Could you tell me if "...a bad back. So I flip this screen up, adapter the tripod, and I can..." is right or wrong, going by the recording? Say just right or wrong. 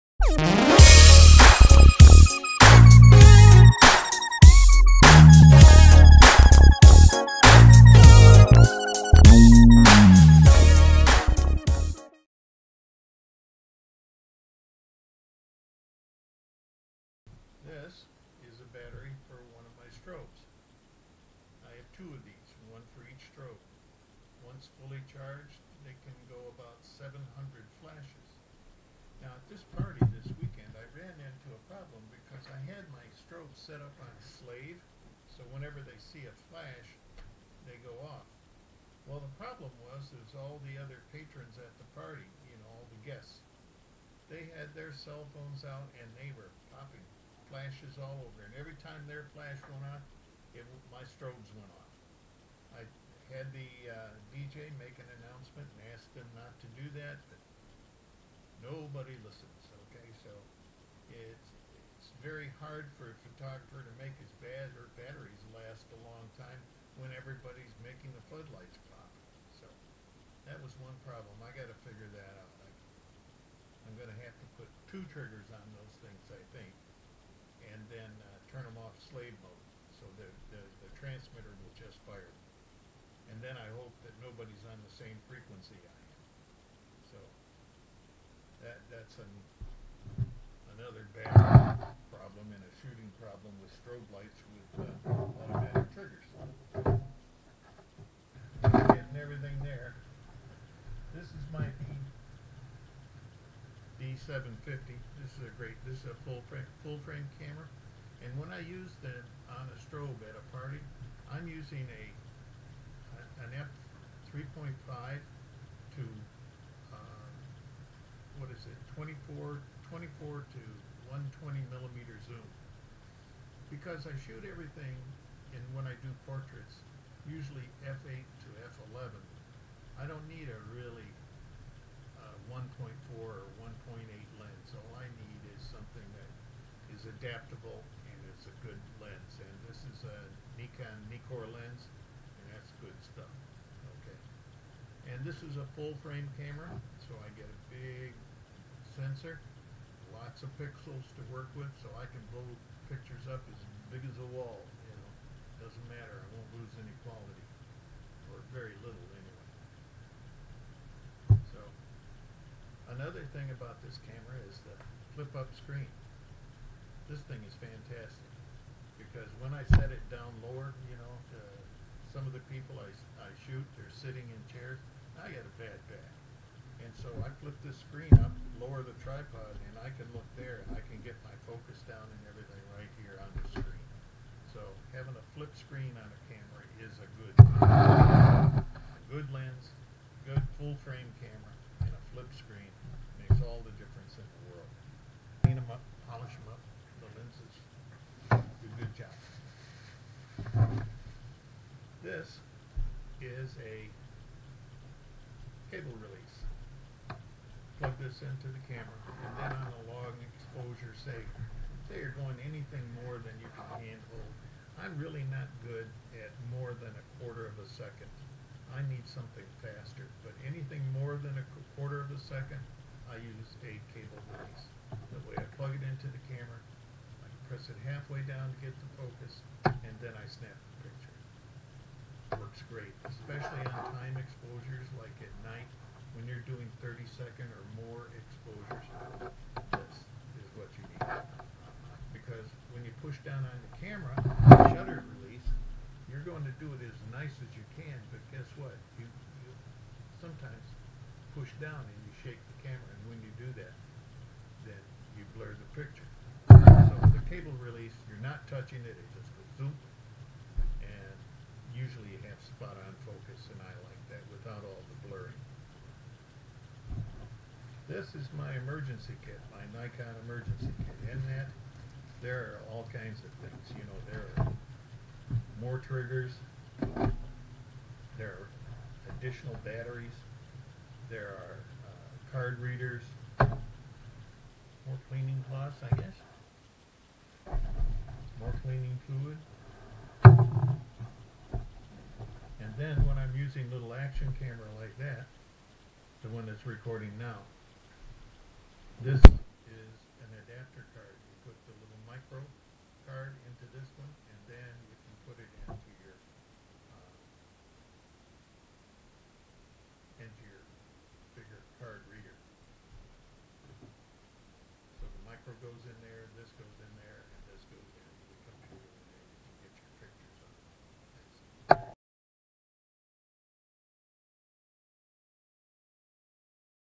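wrong.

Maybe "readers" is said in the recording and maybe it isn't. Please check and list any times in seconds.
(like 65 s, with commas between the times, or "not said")
282 s, 312 s.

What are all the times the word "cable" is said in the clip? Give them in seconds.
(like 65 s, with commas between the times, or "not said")
205 s, 223 s, 257 s.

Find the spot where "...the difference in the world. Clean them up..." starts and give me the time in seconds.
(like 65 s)
193 s.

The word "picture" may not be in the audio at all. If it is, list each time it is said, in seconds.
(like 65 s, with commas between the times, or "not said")
152 s, 230 s, 255 s.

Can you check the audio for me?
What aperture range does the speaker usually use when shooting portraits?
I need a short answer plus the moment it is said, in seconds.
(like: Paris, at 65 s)
f8 to f11, at 127 s.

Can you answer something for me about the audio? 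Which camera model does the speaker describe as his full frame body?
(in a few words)
D750.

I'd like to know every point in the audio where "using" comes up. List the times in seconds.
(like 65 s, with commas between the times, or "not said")
111 s, 293 s.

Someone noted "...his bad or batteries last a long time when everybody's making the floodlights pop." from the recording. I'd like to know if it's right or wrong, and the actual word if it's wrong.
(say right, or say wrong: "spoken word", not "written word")
right.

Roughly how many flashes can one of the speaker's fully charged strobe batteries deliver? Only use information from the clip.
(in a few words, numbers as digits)
700.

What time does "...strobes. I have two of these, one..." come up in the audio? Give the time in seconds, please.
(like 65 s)
19 s.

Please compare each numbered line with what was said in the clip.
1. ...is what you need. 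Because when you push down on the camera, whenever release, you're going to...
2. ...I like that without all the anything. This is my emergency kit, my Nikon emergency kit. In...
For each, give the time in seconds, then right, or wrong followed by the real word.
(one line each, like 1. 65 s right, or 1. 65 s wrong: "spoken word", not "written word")
1. 240 s wrong: "shutter", not "whenever"
2. 263 s wrong: "blurring", not "anything".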